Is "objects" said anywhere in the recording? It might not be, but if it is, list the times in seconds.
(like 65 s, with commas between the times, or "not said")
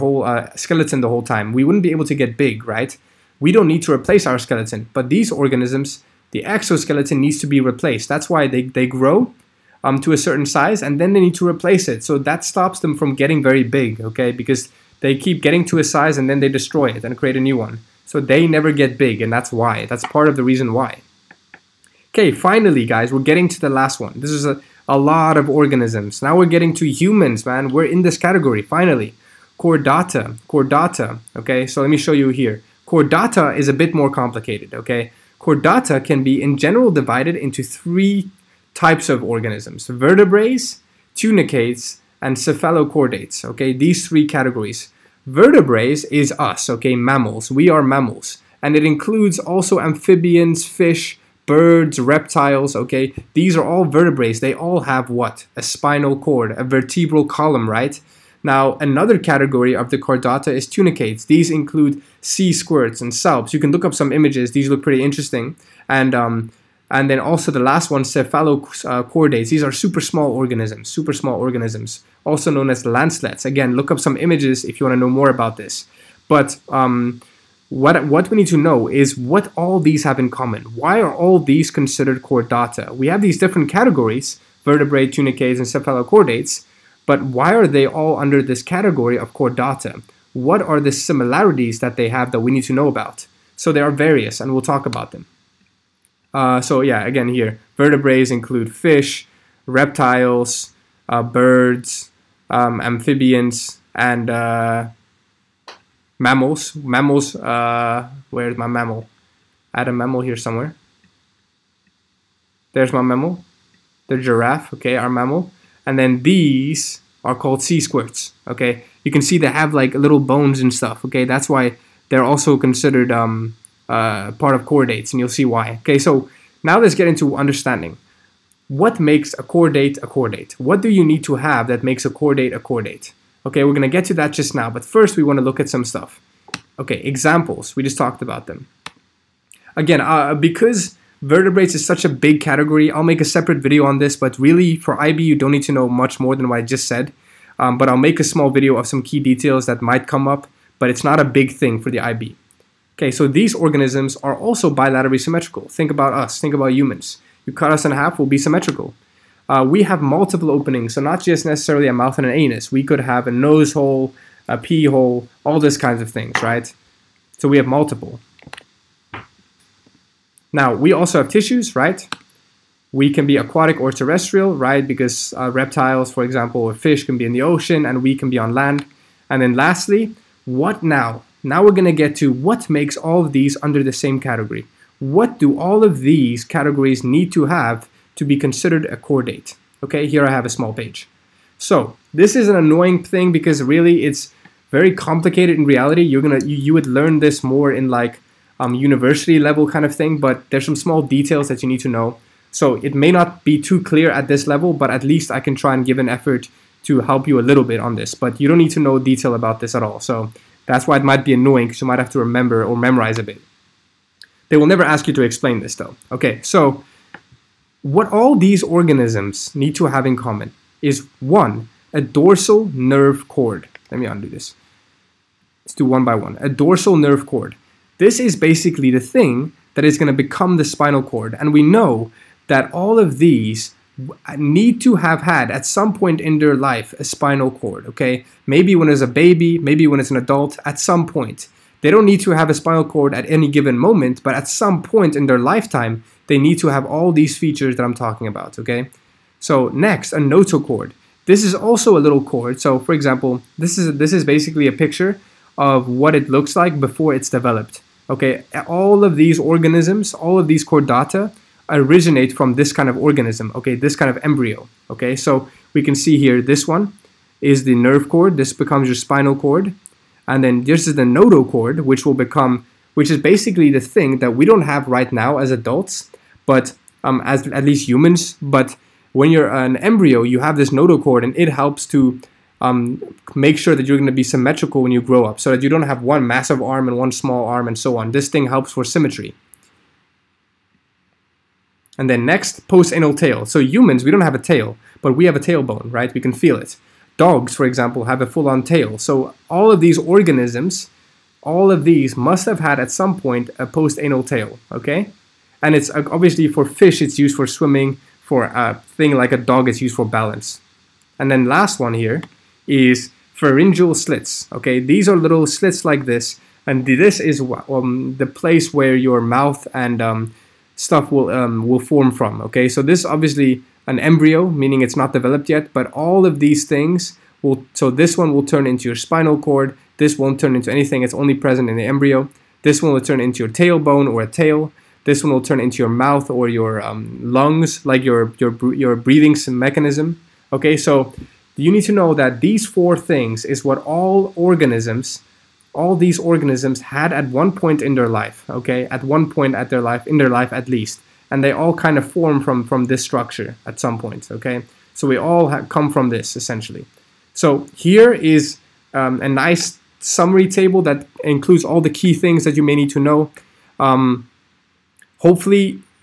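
not said.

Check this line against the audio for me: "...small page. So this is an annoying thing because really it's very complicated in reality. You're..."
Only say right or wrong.
right.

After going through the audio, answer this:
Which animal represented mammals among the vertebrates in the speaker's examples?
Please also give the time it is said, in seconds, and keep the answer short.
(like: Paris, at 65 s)
giraffe, at 114 s.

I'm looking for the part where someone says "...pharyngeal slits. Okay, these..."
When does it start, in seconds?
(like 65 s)
313 s.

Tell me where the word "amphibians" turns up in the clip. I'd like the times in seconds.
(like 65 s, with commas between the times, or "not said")
49 s, 102 s.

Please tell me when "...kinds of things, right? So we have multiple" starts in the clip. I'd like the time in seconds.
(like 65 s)
165 s.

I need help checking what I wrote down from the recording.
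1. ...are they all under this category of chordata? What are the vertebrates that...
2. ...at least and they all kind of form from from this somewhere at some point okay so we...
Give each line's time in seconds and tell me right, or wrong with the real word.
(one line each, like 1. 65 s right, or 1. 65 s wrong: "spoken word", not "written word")
1. 87 s wrong: "similarities", not "vertebrates"
2. 350 s wrong: "structure", not "somewhere".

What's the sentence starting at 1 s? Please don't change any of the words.
We wouldn't be able to get big, right?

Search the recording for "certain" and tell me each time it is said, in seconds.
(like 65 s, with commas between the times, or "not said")
10 s.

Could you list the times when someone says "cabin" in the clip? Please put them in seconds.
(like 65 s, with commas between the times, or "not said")
not said.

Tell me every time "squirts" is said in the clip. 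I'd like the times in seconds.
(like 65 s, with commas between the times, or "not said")
62 s, 117 s.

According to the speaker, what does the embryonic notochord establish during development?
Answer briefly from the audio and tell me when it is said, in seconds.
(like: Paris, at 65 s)
symmetry, at 288 s.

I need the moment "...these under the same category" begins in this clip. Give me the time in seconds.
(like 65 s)
183 s.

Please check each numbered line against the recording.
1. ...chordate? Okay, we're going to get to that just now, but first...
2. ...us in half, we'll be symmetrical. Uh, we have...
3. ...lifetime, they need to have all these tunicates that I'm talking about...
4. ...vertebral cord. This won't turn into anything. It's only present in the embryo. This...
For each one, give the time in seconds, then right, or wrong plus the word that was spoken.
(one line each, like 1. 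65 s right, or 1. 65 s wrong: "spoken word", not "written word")
1. 132 s right
2. 157 s right
3. 245 s wrong: "features", not "tunicates"
4. 328 s wrong: "spinal", not "vertebral".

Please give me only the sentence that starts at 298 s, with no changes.
So all of these organisms, all of these must have had at some point a postanal tail, okay?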